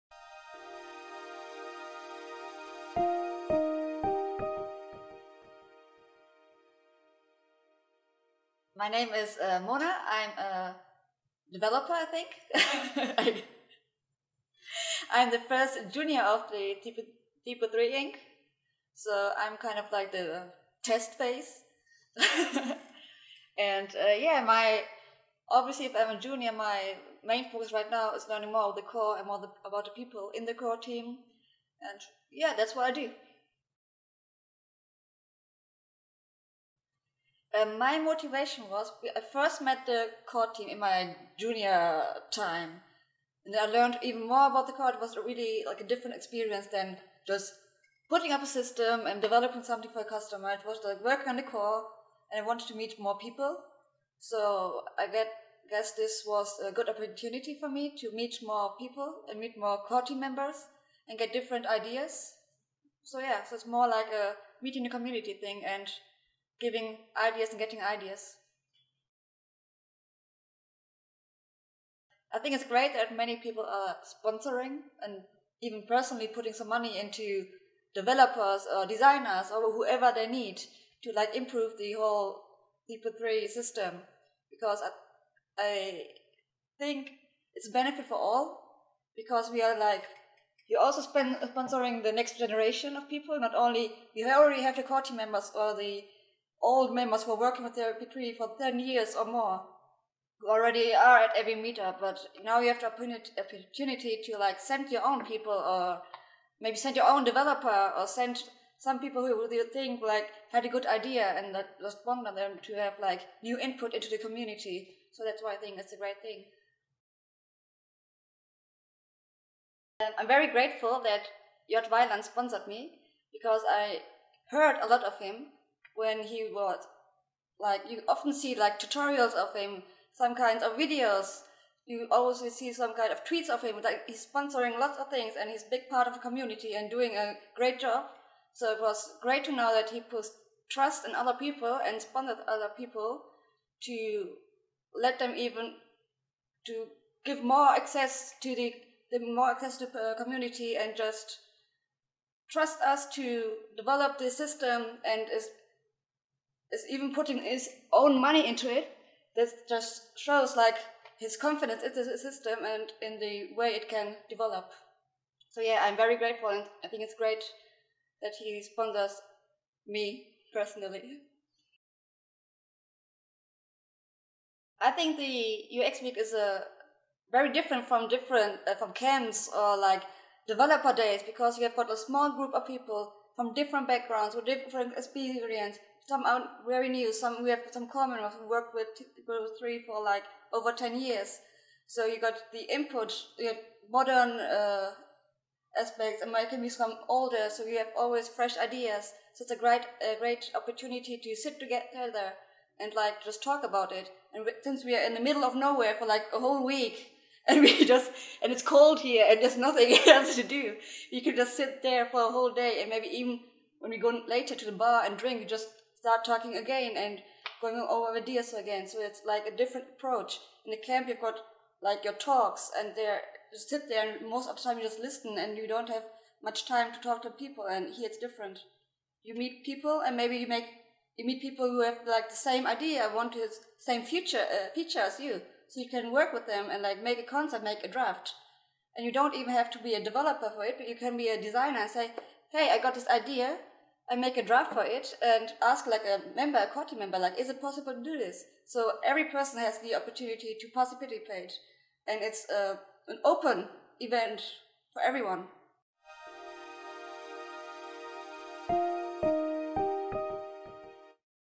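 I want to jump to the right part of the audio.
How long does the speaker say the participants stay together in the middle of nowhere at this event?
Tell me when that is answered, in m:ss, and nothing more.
3:26.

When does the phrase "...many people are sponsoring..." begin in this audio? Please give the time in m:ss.
1:13.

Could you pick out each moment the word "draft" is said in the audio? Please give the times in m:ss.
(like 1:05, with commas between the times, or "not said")
3:57, 4:04.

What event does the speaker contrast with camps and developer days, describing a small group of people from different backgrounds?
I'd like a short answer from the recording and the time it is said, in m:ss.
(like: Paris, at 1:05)
UX Week, at 2:55.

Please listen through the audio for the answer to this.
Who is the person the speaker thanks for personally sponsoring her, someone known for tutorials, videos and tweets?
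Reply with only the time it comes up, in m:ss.
2:01.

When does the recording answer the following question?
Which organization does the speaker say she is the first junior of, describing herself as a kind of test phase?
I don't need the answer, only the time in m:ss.
0:17.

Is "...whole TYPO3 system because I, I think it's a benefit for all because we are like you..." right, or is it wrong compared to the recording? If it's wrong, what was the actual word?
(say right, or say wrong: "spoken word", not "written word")
right.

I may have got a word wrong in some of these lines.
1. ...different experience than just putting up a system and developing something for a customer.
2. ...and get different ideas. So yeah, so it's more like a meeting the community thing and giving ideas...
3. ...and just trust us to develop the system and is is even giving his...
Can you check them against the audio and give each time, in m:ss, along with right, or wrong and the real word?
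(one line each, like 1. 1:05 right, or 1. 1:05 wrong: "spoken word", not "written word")
1. 0:45 right
2. 1:01 right
3. 2:30 wrong: "putting", not "giving".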